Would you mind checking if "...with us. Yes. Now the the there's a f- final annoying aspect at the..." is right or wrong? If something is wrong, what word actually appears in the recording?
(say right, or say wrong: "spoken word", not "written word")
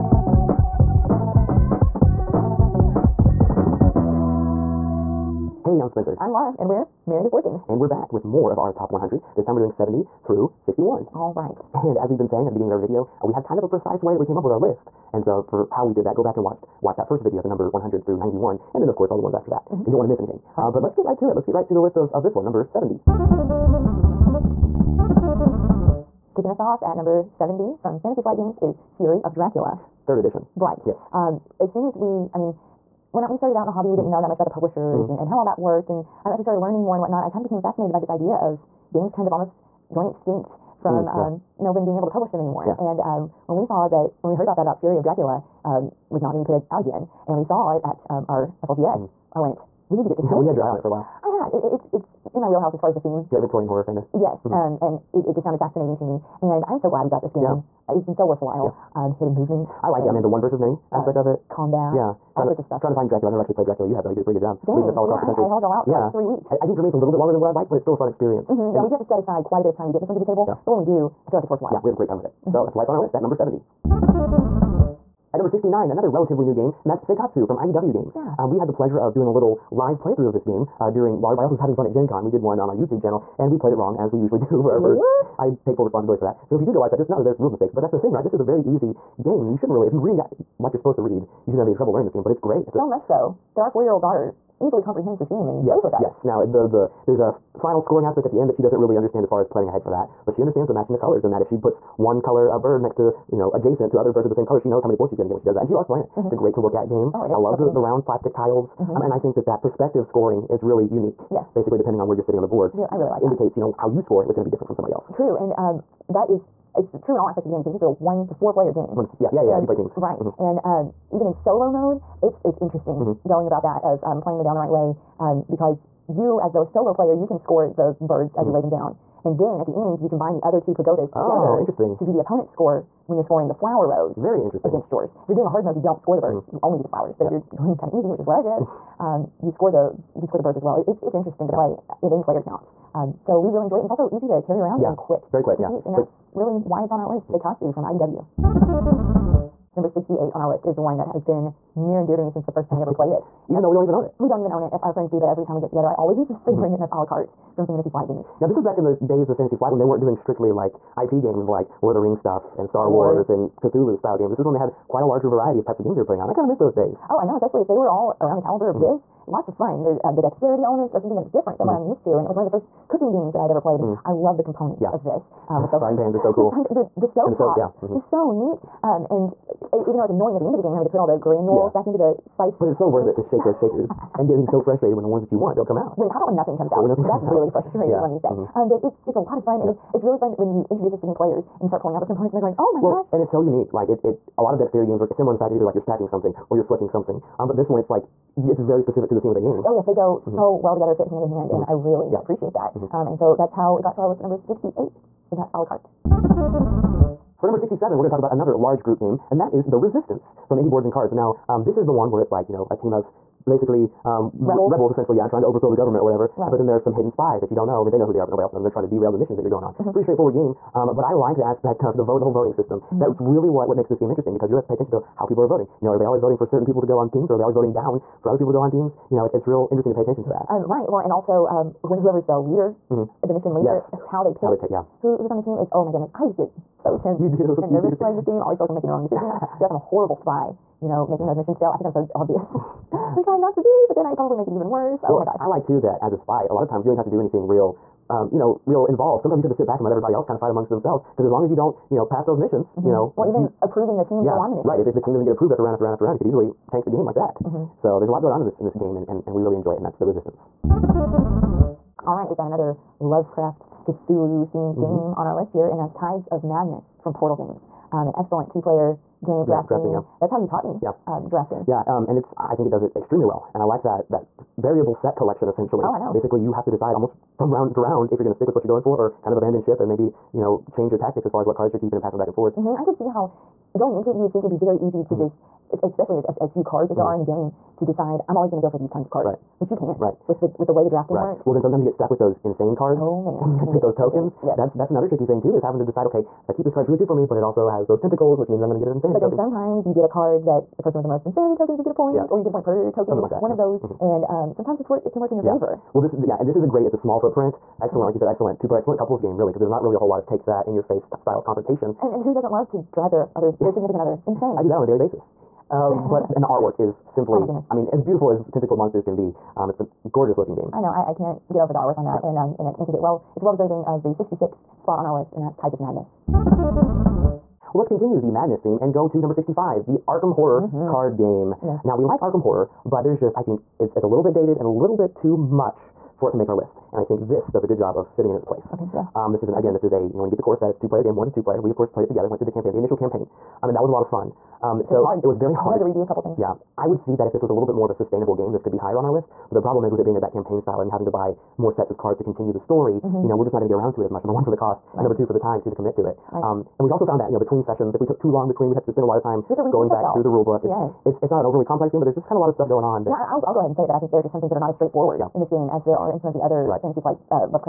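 wrong: "scoring", not "annoying".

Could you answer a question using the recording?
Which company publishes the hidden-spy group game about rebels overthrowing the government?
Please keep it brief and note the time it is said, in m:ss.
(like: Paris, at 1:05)
Indie Boards and Cards, at 3:30.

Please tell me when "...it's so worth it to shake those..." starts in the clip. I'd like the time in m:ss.
3:02.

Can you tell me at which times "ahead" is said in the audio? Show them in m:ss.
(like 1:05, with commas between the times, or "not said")
1:39, 6:03.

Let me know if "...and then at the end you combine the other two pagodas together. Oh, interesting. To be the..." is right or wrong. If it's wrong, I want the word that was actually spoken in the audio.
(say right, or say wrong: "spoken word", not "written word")
right.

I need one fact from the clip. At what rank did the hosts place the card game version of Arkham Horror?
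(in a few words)
65.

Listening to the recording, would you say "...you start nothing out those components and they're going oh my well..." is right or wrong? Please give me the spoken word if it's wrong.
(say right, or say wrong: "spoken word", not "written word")
wrong: "pulling", not "nothing".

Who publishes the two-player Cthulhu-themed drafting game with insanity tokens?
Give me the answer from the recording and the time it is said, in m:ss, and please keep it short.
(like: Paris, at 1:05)
Portal Games, at 4:27.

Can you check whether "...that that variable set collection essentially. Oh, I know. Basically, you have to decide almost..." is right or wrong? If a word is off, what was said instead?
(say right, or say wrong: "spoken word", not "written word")
right.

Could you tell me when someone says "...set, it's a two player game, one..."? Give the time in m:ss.
5:40.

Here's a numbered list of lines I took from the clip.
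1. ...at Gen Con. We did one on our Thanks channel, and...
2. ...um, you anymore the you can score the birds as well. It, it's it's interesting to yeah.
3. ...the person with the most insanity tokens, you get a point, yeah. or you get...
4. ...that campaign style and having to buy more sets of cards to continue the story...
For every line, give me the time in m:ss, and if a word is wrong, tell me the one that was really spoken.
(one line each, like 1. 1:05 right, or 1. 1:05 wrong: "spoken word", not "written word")
1. 1:21 wrong: "YouTube", not "Thanks"
2. 2:19 wrong: "score", not "anymore"
3. 5:00 right
4. 5:50 right.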